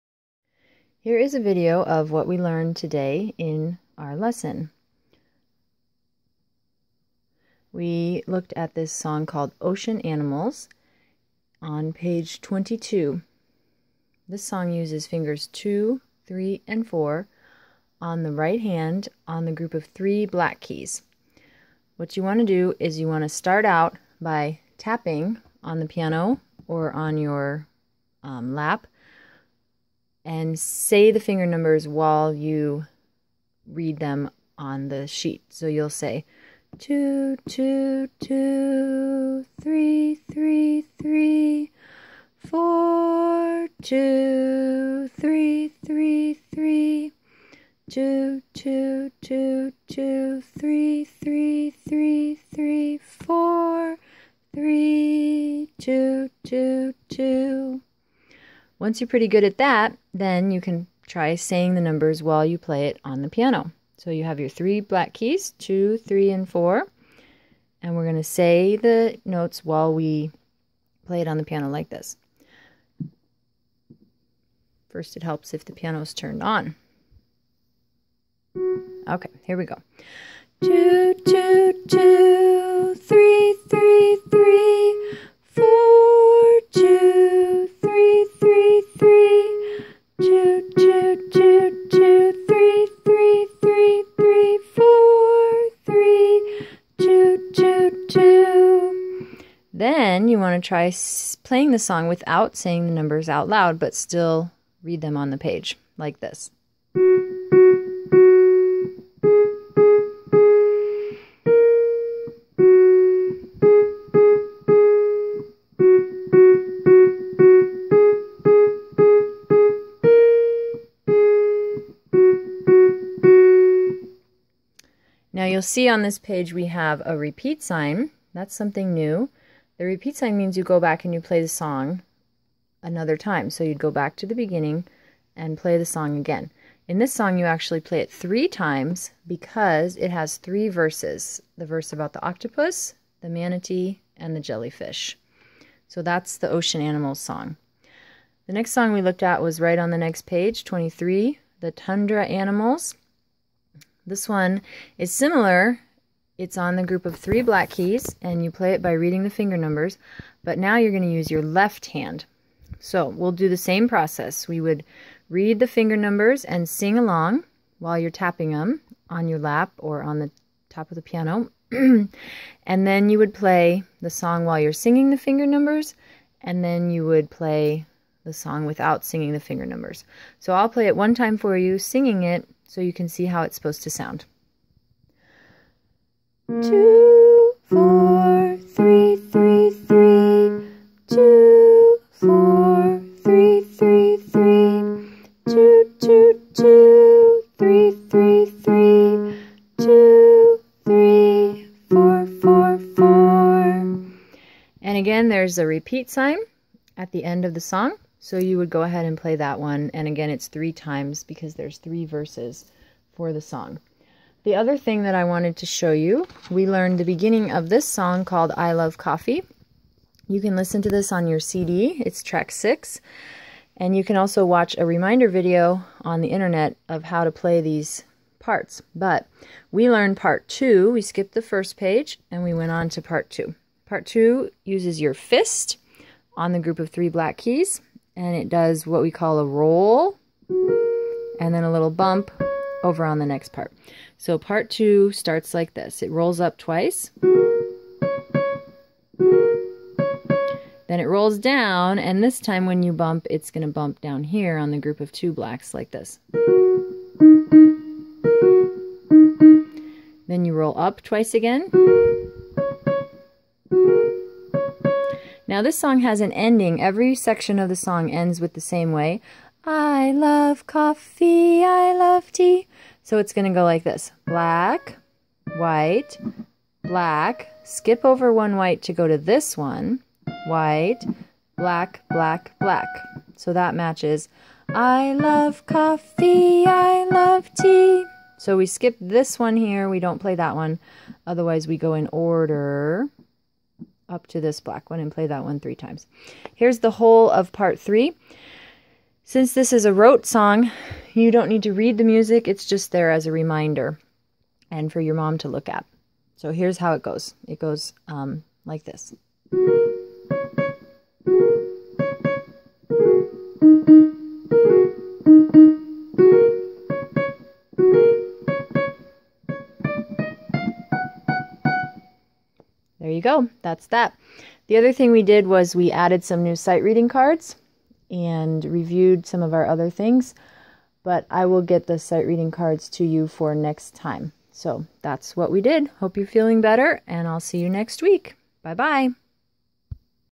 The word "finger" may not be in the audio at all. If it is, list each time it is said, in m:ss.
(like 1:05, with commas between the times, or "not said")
0:15, 0:31, 2:39, 2:45, 2:55, 2:59.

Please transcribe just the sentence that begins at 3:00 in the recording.
So I'll play it one time for you, singing it, so you can see how it's supposed to sound.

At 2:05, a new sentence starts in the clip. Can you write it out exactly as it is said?
you'll see on this page we have a repeat sign.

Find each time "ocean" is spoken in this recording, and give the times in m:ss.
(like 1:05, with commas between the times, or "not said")
0:09, 2:26.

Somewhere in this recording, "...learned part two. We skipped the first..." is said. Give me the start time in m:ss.
3:49.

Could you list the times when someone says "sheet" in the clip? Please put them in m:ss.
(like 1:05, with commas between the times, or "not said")
0:35.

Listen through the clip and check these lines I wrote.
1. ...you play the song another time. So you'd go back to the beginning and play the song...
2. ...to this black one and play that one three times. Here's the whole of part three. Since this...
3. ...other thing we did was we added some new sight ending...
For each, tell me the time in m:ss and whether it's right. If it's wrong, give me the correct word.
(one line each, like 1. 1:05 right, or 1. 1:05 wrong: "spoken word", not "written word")
1. 2:11 right
2. 4:54 right
3. 5:24 wrong: "reading", not "ending".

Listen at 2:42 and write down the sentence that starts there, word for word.
So we'll do the same process.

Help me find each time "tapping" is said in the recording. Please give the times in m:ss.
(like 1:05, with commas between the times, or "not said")
0:24, 2:48.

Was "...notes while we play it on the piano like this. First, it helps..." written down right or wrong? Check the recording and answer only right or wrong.
right.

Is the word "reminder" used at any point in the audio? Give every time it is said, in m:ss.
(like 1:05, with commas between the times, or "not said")
3:44, 5:03.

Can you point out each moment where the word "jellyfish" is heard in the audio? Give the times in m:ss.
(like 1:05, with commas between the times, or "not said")
2:24.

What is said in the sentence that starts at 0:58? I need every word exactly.
Once you're pretty good at that, then you can try saying the numbers while you play it on the piano.